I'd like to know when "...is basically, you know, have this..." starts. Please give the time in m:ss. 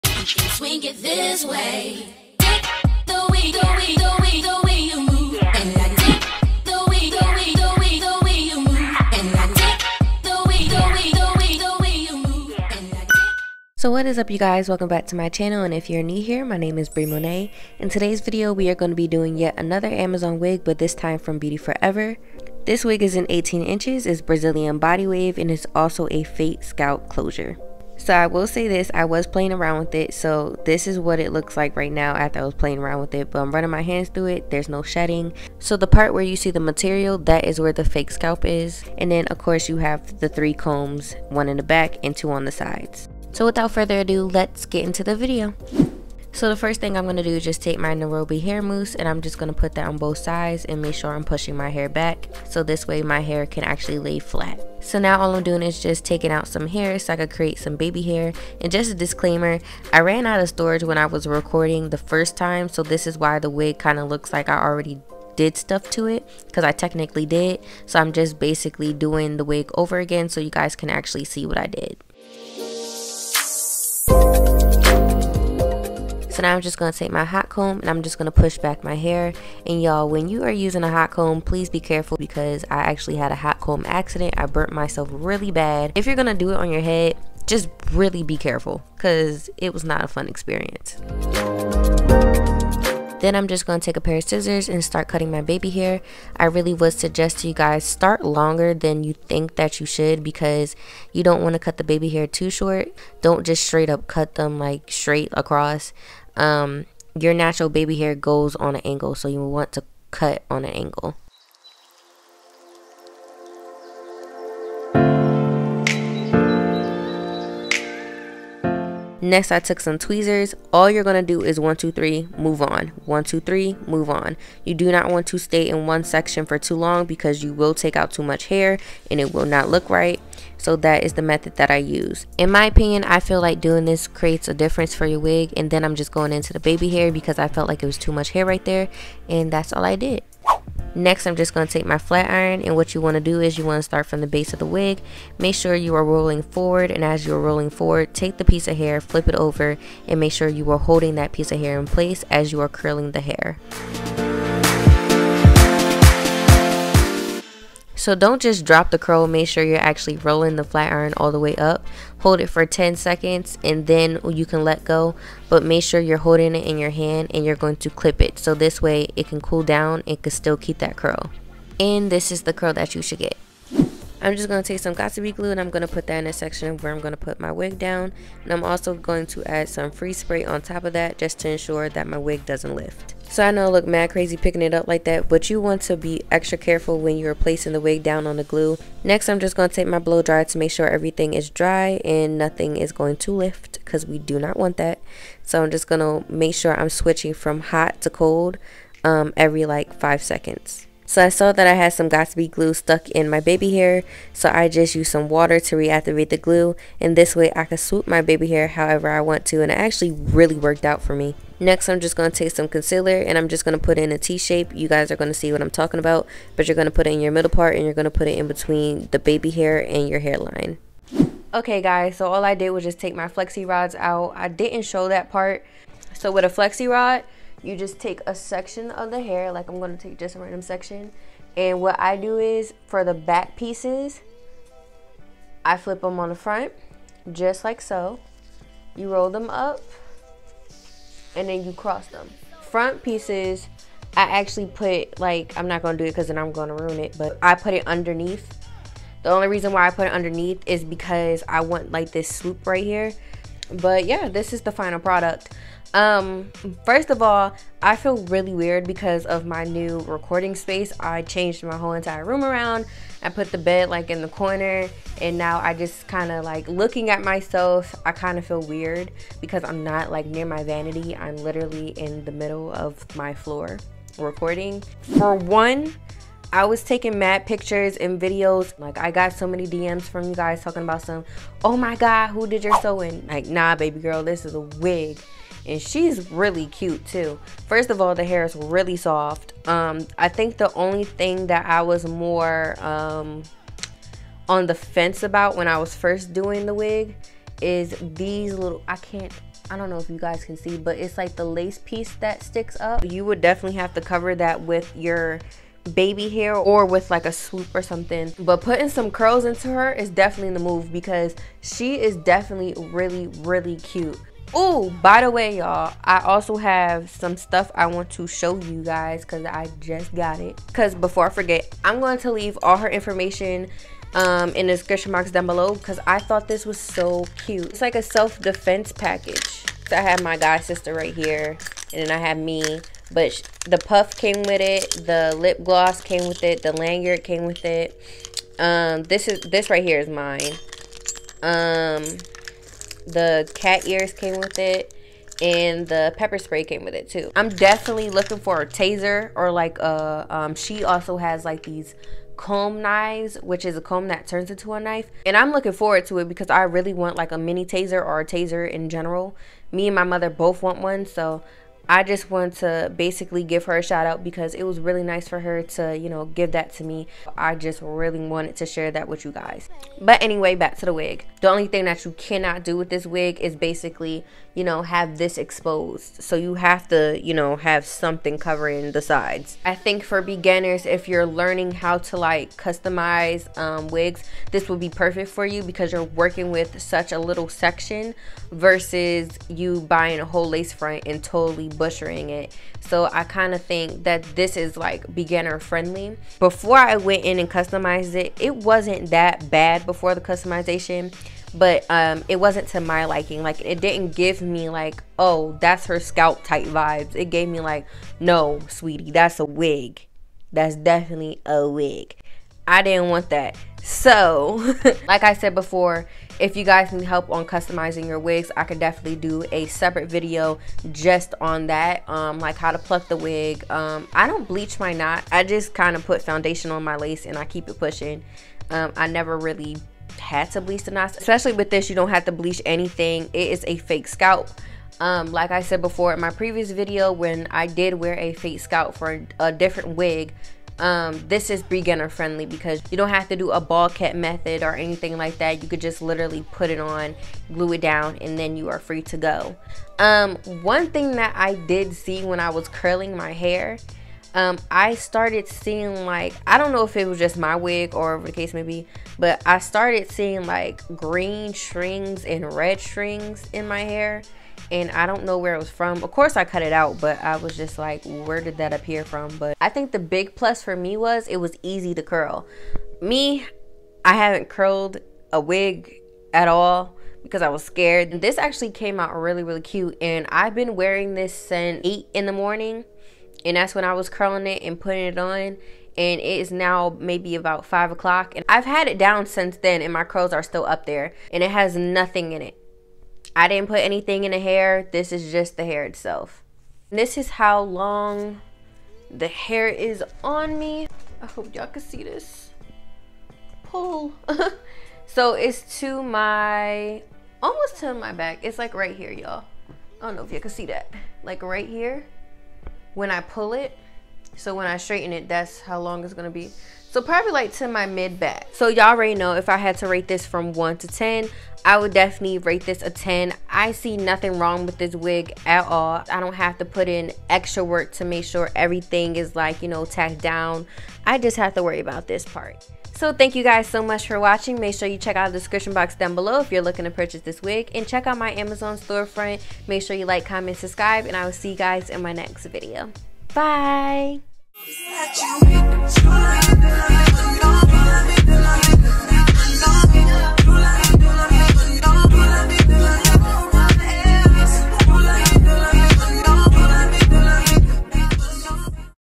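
6:13.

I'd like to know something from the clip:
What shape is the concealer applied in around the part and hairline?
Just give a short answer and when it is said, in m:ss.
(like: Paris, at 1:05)
T-shape, at 3:34.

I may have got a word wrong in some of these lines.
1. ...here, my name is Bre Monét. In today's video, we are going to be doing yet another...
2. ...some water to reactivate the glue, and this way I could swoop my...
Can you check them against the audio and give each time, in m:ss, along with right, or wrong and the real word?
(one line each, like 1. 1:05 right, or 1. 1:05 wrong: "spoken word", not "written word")
1. 0:16 right
2. 3:25 right.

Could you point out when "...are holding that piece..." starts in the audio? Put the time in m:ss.
2:30.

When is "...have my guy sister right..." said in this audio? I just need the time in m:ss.
5:30.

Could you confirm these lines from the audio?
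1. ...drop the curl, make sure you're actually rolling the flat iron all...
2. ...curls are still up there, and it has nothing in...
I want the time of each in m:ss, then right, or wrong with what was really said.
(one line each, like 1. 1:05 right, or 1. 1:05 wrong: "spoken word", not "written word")
1. 2:38 right
2. 8:10 right.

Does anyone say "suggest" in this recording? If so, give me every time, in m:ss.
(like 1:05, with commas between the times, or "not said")
1:36.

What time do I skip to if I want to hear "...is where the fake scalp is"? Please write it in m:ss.
0:37.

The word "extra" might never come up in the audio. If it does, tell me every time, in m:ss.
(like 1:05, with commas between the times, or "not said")
3:06, 8:47.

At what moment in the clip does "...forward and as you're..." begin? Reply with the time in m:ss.
2:26.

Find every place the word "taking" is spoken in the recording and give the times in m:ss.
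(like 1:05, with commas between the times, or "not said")
0:56, 4:36.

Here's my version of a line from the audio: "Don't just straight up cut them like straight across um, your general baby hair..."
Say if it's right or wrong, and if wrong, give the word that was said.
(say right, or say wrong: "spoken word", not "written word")
wrong: "natural", not "general".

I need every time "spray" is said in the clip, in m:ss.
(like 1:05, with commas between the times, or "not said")
3:00, 5:46.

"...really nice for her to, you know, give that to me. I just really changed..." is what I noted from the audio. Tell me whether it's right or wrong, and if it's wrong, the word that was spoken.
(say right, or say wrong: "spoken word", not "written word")
wrong: "wanted", not "changed".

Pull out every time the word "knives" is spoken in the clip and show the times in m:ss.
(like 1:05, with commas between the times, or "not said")
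5:52.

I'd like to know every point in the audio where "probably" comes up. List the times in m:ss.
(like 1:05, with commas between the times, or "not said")
8:37.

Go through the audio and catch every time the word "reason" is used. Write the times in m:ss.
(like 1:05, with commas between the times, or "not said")
4:09.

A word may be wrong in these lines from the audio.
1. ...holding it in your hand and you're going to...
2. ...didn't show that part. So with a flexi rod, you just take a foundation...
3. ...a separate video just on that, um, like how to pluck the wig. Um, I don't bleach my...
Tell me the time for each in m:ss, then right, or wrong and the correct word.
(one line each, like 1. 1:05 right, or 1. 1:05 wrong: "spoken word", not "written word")
1. 2:46 right
2. 3:44 wrong: "section", not "foundation"
3. 6:59 right.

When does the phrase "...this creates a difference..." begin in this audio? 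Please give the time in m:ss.
2:13.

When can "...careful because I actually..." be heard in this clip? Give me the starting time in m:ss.
1:21.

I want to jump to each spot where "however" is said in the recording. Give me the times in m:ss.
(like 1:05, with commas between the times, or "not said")
3:28.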